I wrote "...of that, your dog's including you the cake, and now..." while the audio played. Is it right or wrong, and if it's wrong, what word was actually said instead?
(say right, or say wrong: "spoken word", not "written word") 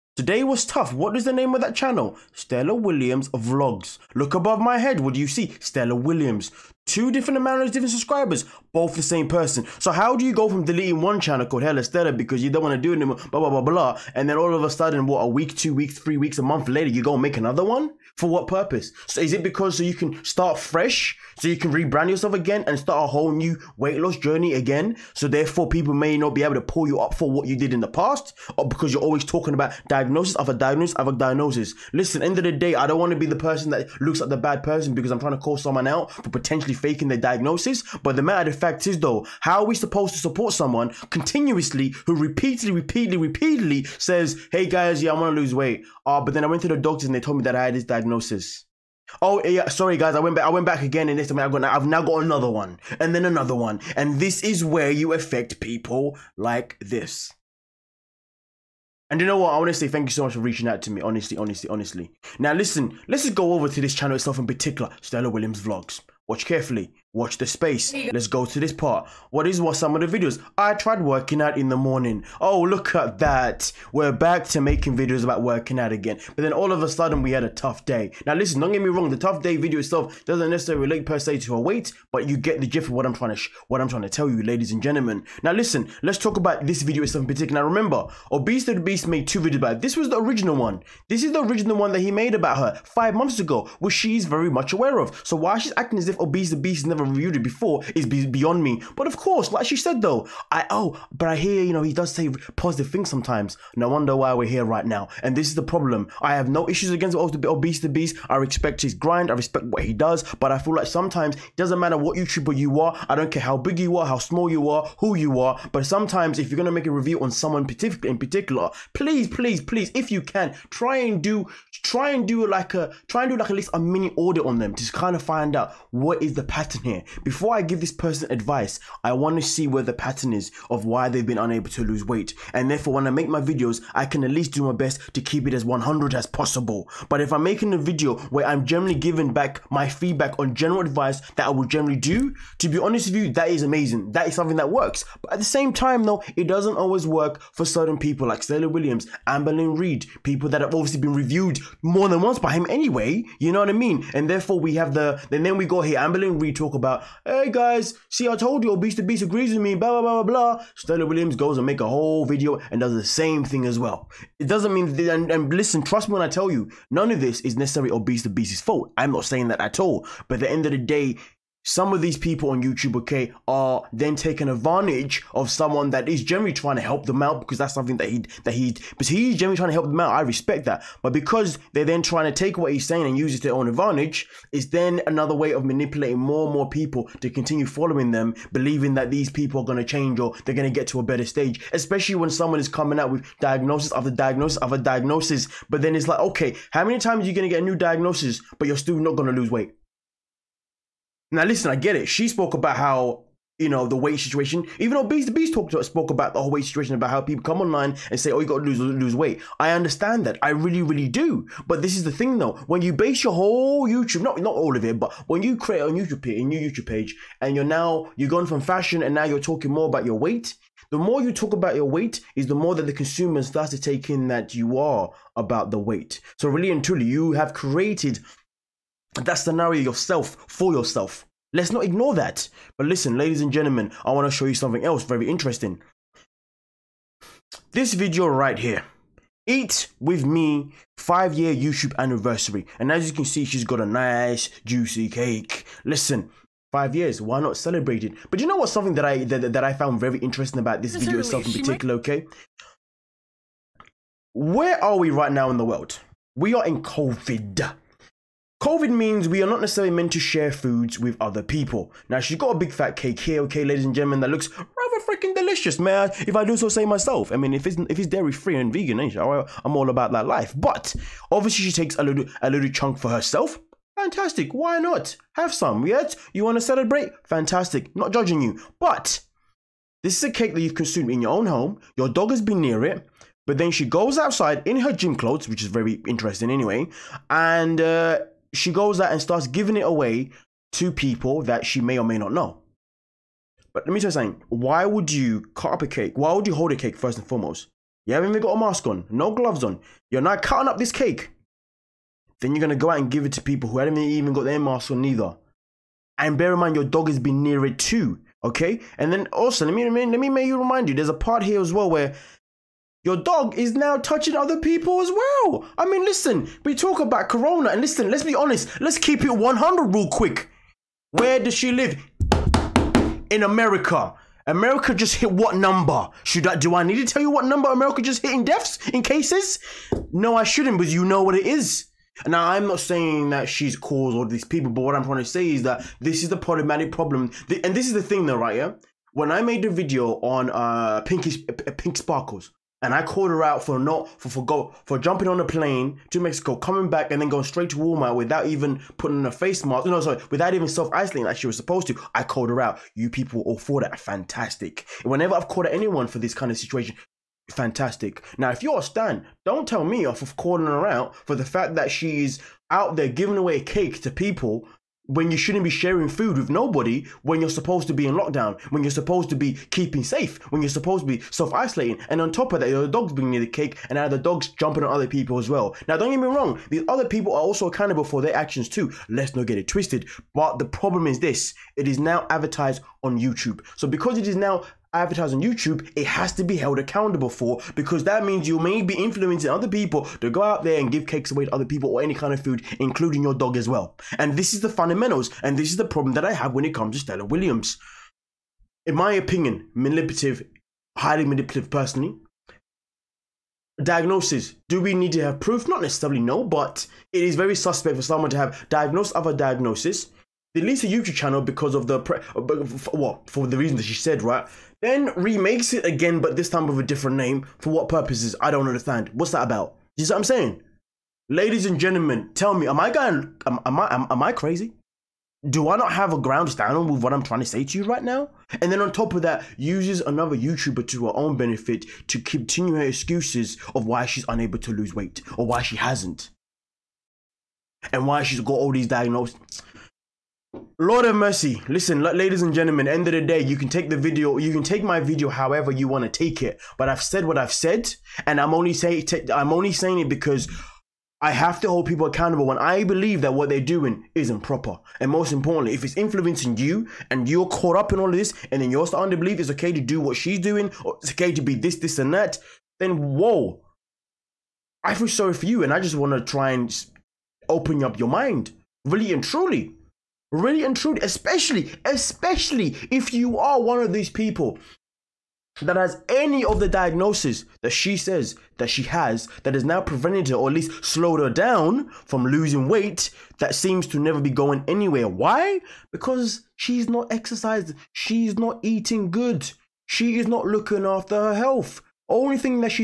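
wrong: "bringing", not "including".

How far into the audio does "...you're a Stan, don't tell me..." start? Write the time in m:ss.
5:58.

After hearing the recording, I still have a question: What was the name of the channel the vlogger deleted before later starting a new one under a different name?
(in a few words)
Hella.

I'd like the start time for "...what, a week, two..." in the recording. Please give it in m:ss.
0:15.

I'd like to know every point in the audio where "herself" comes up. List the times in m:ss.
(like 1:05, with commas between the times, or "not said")
4:33.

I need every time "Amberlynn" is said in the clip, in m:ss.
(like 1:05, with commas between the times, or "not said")
2:29, 2:35.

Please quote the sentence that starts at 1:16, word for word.
But then all of a sudden we had a tough day.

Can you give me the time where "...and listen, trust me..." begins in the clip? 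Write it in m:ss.
2:45.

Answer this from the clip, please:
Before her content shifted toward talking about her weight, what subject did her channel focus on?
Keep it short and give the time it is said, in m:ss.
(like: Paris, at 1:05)
Fashion, at 3:38.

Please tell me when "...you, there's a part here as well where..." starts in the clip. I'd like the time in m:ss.
5:10.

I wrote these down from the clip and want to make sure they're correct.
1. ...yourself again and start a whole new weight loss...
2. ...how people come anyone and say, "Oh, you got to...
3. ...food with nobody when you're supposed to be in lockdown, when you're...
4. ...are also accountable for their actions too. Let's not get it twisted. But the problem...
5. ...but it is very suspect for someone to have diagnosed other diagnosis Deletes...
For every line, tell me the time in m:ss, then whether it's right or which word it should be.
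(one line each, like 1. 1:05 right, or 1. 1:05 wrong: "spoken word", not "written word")
1. 0:22 right
2. 3:27 wrong: "online", not "anyone"
3. 6:06 right
4. 6:17 right
5. 6:46 right.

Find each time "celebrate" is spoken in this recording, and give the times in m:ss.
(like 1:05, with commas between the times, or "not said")
4:07, 4:36.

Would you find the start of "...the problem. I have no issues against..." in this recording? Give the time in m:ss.
1:45.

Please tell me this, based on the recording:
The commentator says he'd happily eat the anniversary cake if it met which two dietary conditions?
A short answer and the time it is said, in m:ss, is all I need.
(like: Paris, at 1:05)
Dairy free and vegan, at 4:28.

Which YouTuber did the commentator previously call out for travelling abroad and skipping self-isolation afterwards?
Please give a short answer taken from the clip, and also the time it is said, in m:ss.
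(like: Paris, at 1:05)
Pinky Pink Sparkles, at 5:41.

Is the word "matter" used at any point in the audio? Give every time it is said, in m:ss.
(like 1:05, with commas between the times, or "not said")
0:38, 1:51.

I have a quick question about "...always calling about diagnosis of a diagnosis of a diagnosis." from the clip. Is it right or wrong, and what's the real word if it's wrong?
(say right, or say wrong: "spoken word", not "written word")
wrong: "talking", not "calling".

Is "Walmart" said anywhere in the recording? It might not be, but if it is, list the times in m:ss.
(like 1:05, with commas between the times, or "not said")
5:47.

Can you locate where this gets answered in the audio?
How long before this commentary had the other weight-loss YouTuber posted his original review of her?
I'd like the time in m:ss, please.
1:32.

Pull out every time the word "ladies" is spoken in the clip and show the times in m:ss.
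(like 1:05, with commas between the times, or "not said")
1:24, 3:53, 4:23, 7:01, 7:22.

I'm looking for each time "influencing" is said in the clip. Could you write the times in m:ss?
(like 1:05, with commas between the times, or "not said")
6:28, 7:35.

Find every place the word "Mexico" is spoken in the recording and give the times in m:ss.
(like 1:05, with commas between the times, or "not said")
5:46.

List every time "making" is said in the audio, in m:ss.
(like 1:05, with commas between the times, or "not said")
1:14, 2:17.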